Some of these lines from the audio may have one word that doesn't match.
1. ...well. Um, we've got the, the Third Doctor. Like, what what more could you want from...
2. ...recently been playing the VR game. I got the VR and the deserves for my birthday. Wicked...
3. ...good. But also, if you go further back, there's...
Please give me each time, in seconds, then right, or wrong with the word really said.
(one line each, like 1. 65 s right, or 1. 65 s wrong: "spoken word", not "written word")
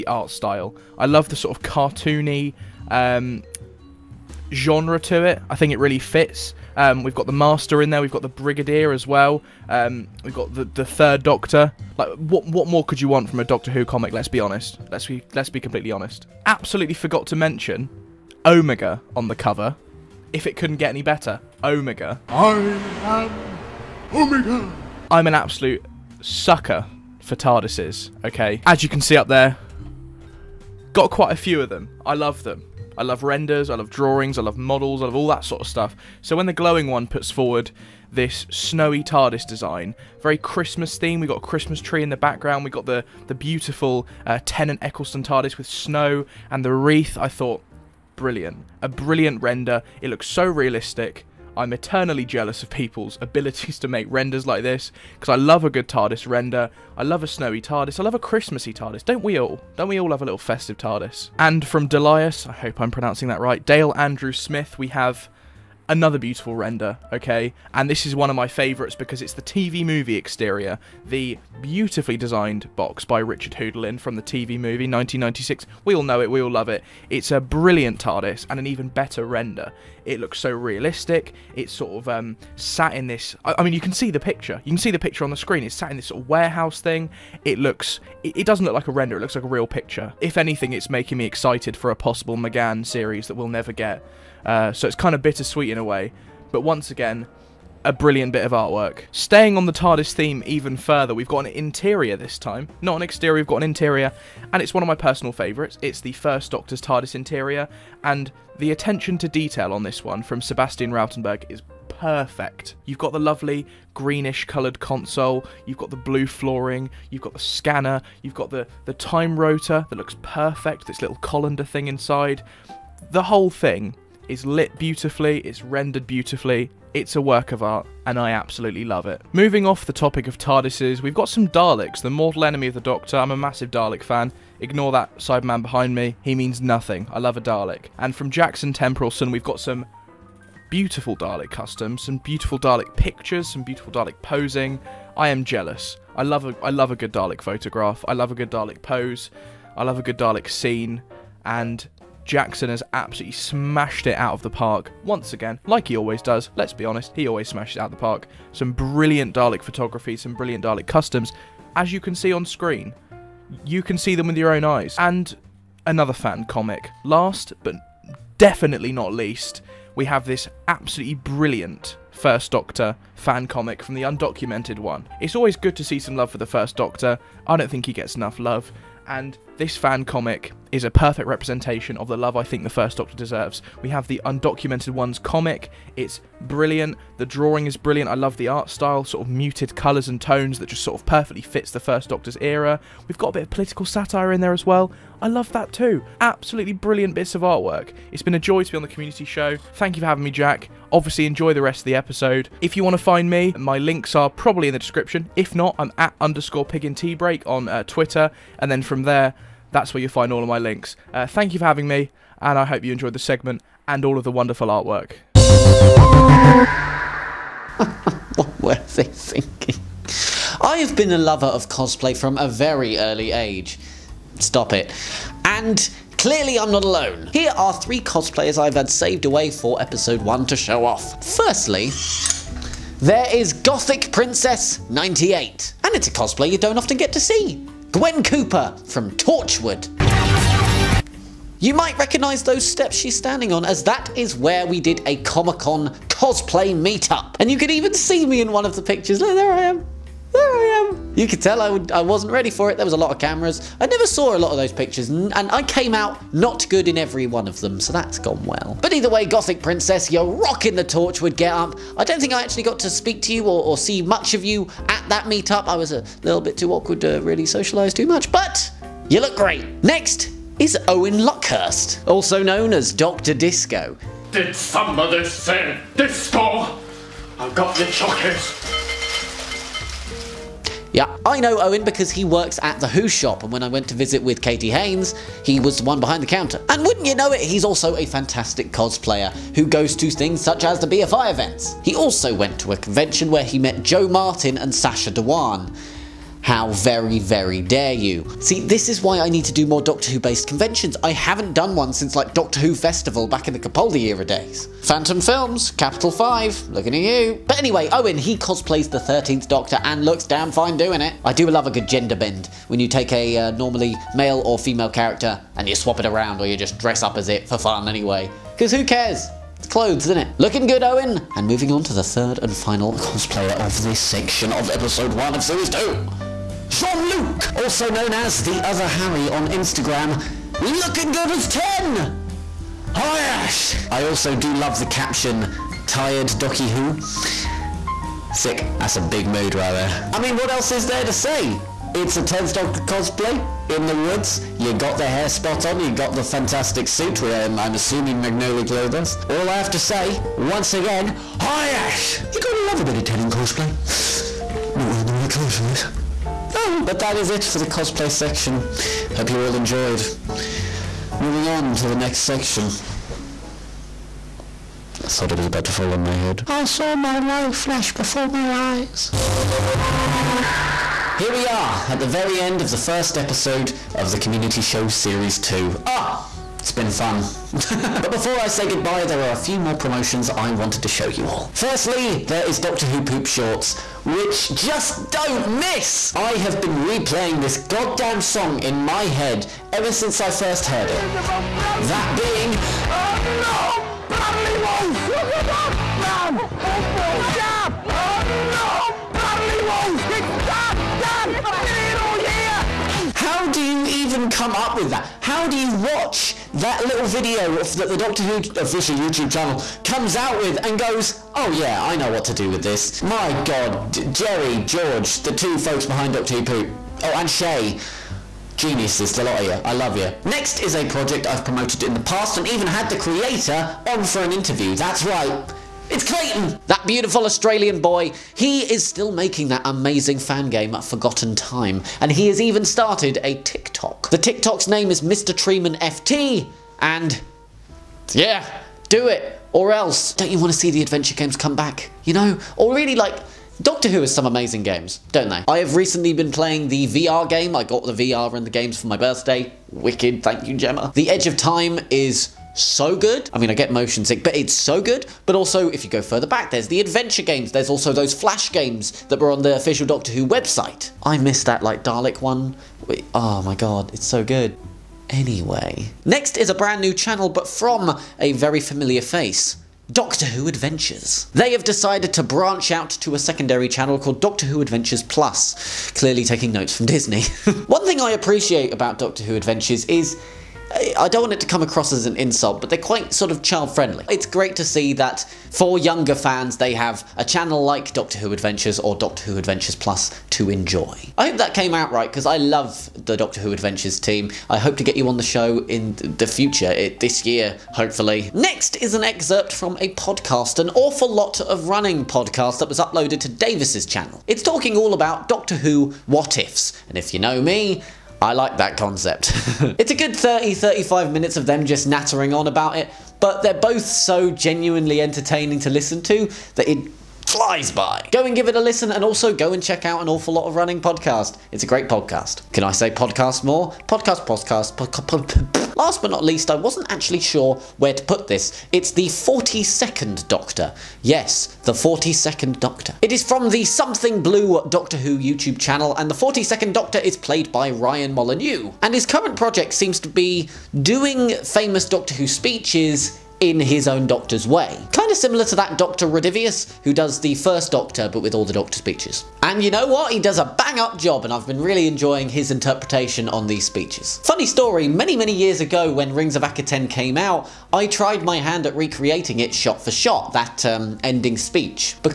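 1. 9 s right
2. 445 s wrong: "games", not "deserves"
3. 454 s right.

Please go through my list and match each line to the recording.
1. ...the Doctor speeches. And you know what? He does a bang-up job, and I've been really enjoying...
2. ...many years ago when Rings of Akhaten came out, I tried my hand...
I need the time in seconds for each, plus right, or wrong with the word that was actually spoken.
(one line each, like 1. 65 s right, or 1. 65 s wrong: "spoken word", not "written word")
1. 548 s right
2. 555 s right.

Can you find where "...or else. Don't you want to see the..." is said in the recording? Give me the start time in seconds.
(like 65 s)
439 s.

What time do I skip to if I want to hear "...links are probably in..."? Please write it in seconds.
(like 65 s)
203 s.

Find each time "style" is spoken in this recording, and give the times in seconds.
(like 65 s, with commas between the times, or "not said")
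0 s, 188 s.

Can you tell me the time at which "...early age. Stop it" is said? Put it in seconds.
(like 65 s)
222 s.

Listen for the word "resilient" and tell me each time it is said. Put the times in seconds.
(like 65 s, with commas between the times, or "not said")
not said.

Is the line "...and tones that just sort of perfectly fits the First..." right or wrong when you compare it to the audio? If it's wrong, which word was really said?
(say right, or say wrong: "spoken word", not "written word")
right.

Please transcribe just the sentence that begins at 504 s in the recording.
It's talking all about Doctor Who what ifs, and if you know me, I like that concept.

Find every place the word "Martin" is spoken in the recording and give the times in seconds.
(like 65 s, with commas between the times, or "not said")
294 s.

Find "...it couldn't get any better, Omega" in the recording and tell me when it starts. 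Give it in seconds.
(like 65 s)
20 s.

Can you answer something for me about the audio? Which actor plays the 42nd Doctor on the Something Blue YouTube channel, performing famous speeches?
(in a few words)
Ryan Molyneux.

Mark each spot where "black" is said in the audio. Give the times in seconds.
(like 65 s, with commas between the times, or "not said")
not said.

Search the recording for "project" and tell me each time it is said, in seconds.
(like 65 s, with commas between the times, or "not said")
420 s, 539 s.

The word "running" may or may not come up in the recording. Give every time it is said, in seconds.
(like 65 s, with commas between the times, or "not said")
501 s, 520 s.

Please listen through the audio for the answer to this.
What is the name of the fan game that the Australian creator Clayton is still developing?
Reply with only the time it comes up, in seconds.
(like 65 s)
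430 s.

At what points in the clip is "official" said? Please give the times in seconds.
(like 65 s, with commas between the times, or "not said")
408 s, 459 s.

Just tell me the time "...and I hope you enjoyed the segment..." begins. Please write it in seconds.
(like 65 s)
212 s.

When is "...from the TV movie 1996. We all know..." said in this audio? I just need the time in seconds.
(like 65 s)
73 s.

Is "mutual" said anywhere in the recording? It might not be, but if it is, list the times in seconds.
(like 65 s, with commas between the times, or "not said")
not said.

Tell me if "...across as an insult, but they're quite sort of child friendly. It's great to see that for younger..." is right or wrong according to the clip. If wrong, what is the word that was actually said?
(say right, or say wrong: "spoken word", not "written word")
right.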